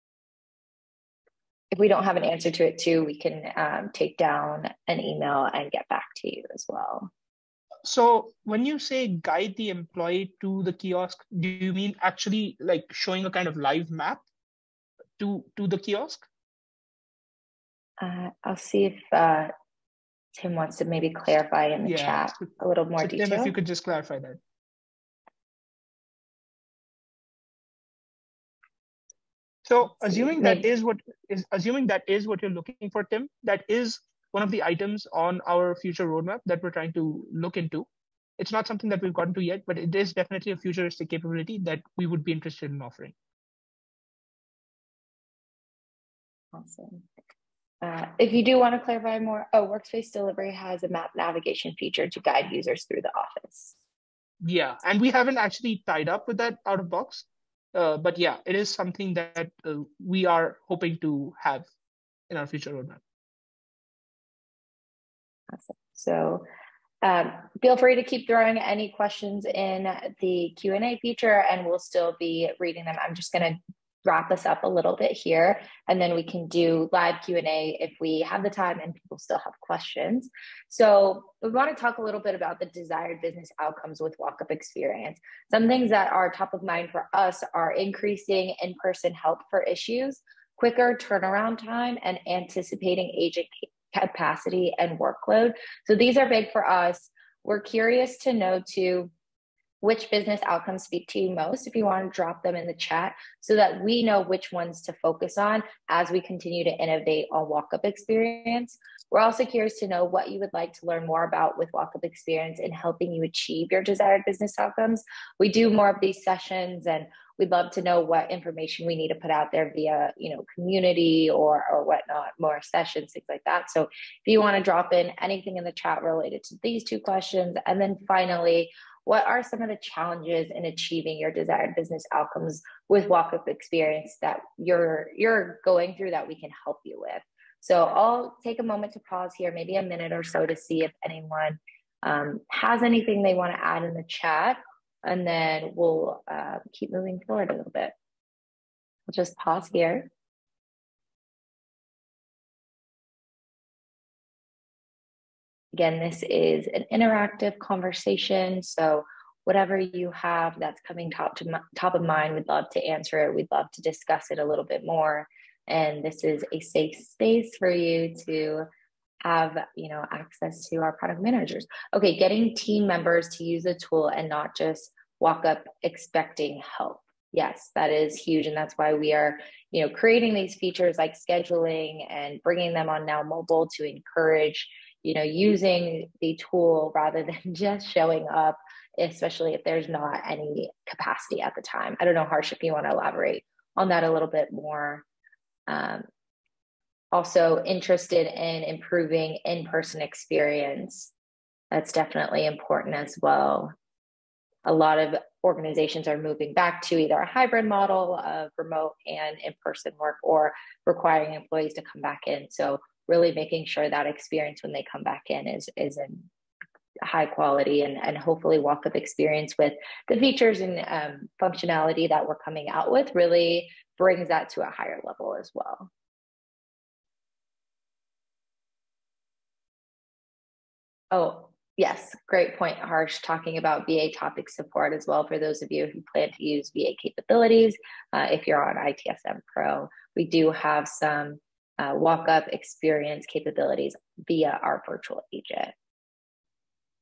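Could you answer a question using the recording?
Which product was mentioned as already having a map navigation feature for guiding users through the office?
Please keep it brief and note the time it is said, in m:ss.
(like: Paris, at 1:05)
Workplace Delivery, at 0:49.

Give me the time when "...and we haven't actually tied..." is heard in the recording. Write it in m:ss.
0:54.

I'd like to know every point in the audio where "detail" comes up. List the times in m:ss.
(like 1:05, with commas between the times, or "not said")
0:23.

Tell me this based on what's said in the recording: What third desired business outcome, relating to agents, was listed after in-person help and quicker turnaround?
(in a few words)
Anticipating agent capacity and workload.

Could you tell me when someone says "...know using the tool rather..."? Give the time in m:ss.
3:05.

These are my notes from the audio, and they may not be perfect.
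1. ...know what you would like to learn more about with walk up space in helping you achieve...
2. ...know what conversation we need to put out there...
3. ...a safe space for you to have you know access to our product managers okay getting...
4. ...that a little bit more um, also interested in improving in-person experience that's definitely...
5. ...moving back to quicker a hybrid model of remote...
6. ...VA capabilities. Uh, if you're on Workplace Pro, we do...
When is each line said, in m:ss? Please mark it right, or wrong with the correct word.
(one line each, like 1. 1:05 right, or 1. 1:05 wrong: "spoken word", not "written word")
1. 1:49 wrong: "experience", not "space"
2. 1:57 wrong: "information", not "conversation"
3. 2:46 right
4. 3:13 right
5. 3:26 wrong: "either", not "quicker"
6. 3:56 wrong: "ITSM", not "Workplace".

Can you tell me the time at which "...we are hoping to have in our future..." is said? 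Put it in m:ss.
1:00.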